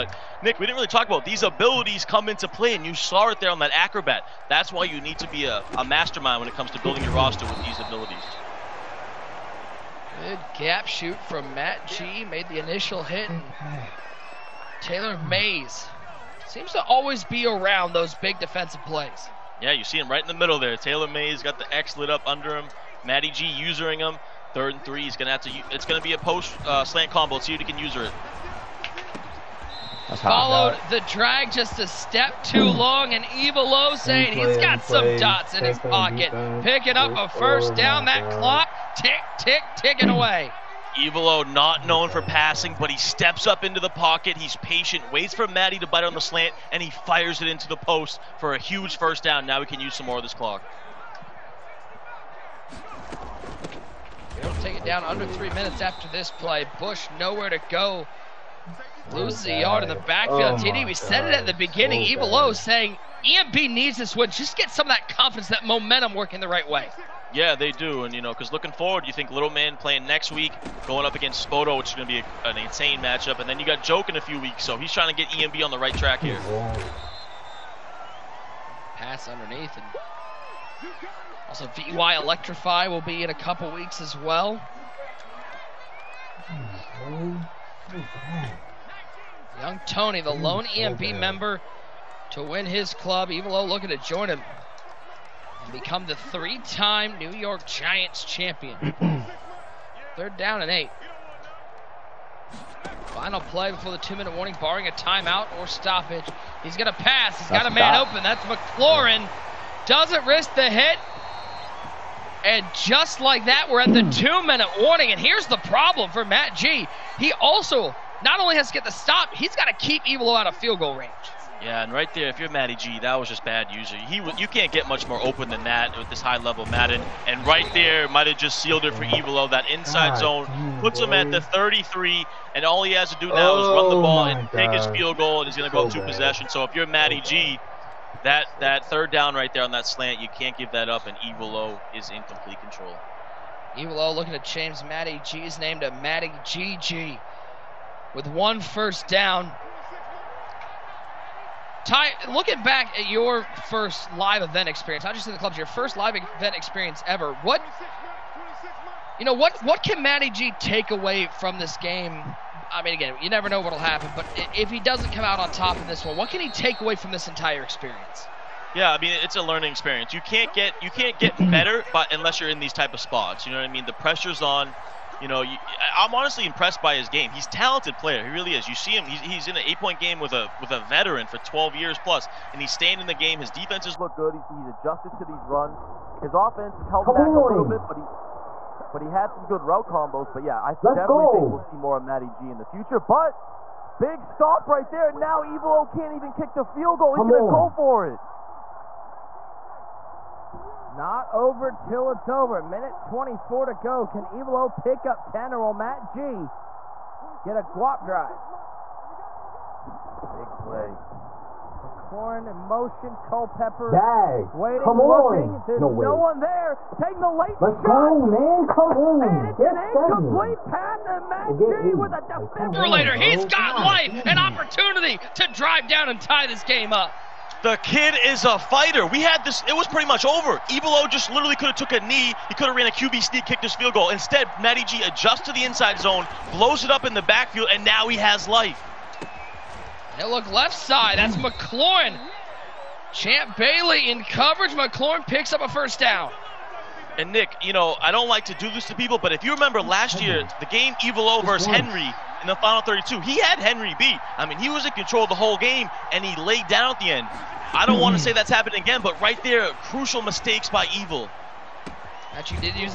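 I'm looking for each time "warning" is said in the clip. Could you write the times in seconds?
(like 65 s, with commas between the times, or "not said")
104 s, 114 s.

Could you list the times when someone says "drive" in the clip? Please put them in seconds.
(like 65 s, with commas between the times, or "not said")
208 s, 225 s.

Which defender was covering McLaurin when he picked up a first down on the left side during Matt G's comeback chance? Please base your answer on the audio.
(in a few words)
Champ Bailey.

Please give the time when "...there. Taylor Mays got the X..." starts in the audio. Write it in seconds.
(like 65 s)
20 s.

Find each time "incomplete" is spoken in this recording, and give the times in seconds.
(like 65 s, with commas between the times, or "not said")
220 s.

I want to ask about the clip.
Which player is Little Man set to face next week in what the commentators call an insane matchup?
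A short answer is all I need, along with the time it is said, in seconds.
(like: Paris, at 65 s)
Spoto, at 71 s.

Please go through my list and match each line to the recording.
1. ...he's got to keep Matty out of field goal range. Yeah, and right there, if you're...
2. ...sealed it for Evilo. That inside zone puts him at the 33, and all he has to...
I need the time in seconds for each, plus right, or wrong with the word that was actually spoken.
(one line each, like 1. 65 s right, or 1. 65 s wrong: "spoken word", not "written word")
1. 119 s wrong: "Evil", not "Matty"
2. 128 s right.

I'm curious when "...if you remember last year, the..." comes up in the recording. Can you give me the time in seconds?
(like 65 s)
249 s.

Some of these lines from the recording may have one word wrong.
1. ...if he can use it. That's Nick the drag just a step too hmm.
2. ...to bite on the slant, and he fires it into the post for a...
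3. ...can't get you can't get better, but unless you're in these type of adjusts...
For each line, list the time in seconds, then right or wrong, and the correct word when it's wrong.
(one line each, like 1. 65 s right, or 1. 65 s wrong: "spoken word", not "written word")
1. 27 s wrong: "Followed", not "Nick"
2. 45 s right
3. 170 s wrong: "spots", not "adjusts".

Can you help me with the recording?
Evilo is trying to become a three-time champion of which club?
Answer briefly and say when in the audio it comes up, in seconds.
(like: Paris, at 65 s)
New York Giants, at 97 s.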